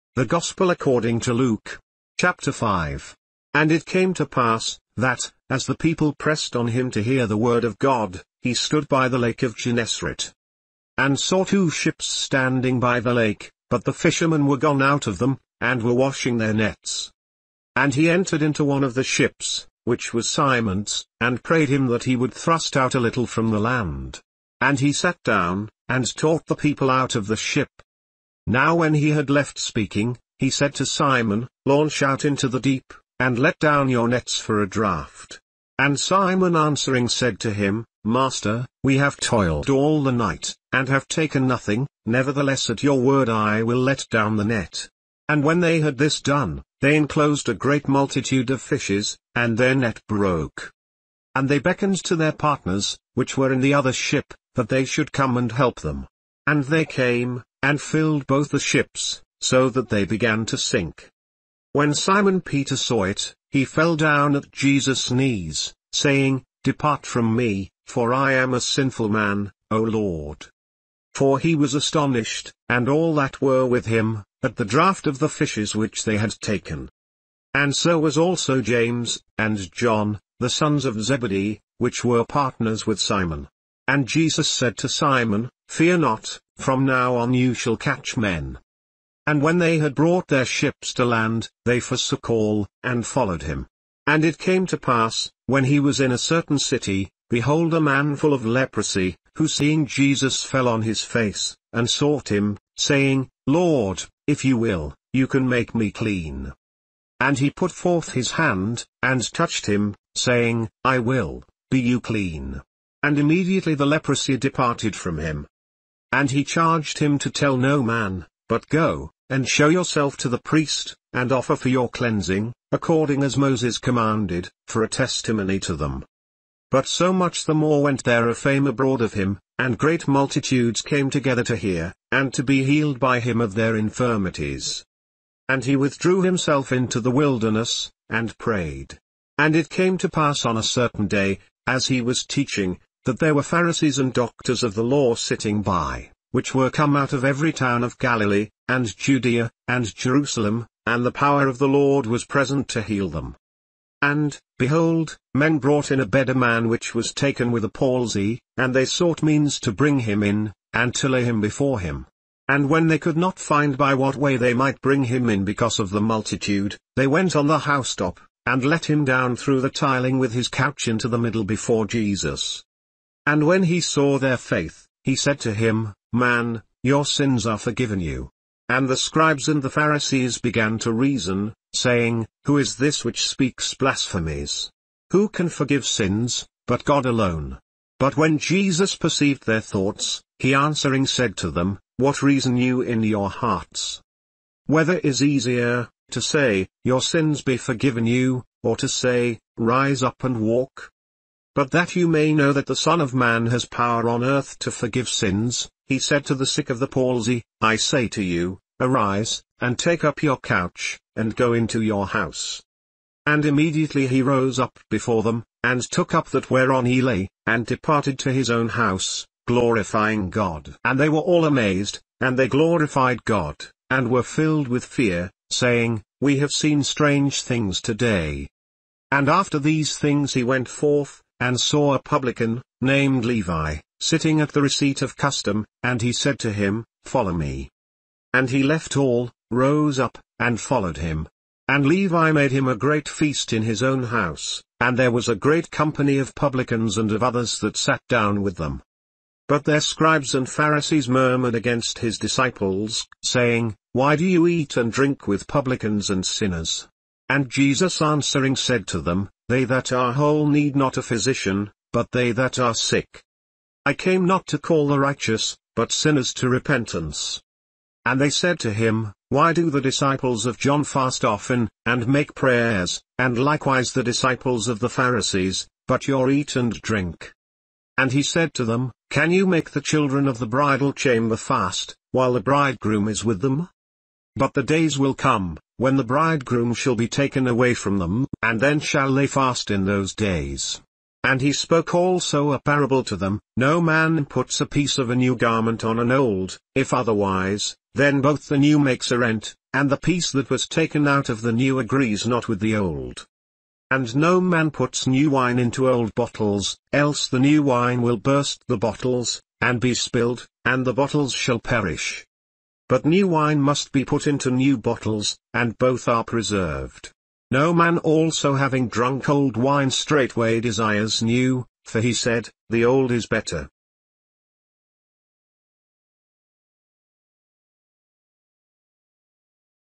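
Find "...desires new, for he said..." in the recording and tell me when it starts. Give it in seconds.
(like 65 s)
320 s.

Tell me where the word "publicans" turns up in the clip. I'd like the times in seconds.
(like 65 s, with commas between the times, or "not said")
231 s, 246 s, 255 s.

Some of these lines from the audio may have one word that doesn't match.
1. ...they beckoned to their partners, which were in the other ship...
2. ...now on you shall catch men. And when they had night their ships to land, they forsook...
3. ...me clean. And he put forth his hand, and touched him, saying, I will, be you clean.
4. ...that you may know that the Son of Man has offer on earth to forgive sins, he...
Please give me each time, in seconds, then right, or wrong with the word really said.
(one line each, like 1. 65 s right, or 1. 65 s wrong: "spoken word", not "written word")
1. 51 s right
2. 86 s wrong: "brought", not "night"
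3. 105 s right
4. 201 s wrong: "power", not "offer".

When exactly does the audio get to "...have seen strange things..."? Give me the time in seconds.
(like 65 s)
226 s.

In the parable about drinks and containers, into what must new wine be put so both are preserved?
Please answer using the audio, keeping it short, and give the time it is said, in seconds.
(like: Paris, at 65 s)
New bottles, at 314 s.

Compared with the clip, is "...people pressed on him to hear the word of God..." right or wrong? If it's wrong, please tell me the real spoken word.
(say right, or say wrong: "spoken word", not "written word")
right.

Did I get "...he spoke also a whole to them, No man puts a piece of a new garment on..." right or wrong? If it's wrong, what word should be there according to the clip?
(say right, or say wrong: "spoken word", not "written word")
wrong: "parable", not "whole".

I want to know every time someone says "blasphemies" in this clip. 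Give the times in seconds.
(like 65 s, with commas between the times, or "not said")
183 s.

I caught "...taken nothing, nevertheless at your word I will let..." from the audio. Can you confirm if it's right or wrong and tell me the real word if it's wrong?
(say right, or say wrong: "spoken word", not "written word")
right.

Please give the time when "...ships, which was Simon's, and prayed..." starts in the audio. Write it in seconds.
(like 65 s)
19 s.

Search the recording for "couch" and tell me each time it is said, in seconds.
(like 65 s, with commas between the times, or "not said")
170 s, 210 s.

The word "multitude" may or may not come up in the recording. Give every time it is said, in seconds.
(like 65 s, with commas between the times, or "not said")
47 s, 130 s, 166 s.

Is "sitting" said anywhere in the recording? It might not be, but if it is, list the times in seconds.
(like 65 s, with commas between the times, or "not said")
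145 s, 233 s.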